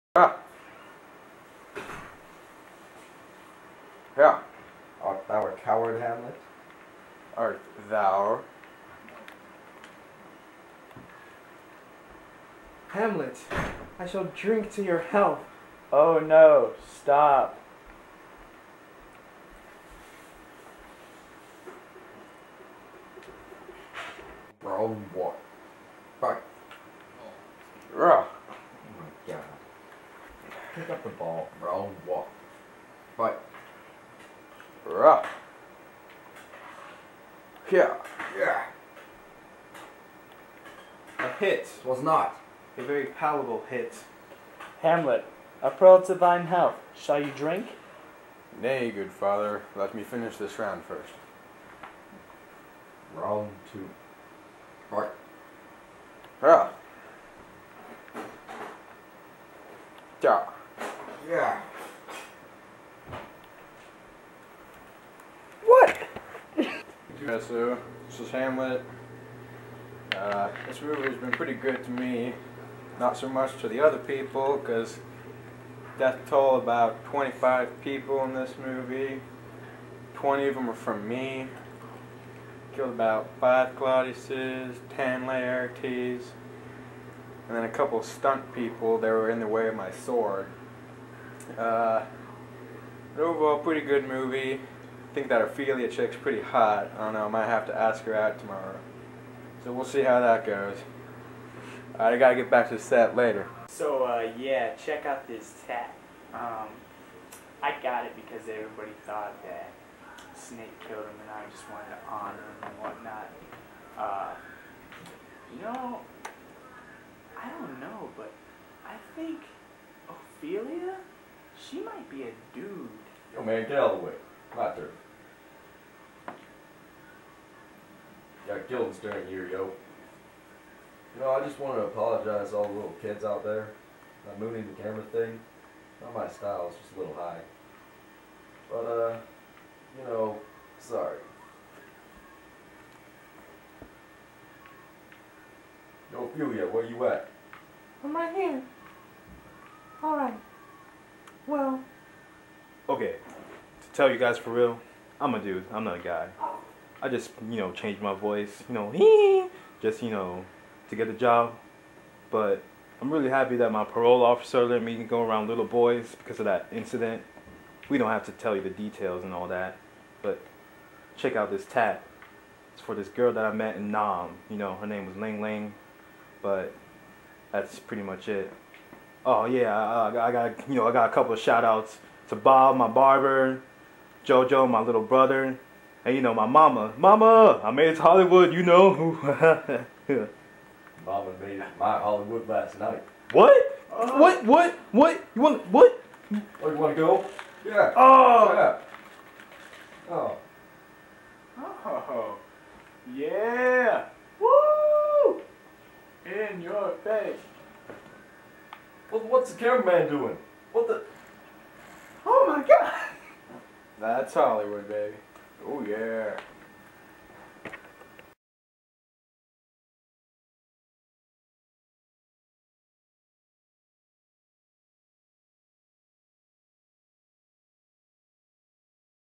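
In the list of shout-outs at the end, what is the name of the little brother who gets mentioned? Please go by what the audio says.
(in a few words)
Jojo.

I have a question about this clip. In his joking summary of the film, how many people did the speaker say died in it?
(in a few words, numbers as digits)
25.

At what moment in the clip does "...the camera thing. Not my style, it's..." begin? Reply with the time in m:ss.
2:14.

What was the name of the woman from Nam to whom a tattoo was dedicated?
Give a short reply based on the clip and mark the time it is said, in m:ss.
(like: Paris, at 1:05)
Ling Ling, at 2:55.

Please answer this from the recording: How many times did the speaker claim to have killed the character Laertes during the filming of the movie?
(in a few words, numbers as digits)
10.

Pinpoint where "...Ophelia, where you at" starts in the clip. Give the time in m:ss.
2:26.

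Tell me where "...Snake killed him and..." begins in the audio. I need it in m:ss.
1:50.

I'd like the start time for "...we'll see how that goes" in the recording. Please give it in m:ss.
1:39.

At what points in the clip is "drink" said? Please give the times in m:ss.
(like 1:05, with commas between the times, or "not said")
0:14, 0:47.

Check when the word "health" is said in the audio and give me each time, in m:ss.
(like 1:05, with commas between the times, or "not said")
0:14, 0:46.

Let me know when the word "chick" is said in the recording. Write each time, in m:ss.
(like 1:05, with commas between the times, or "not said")
1:35.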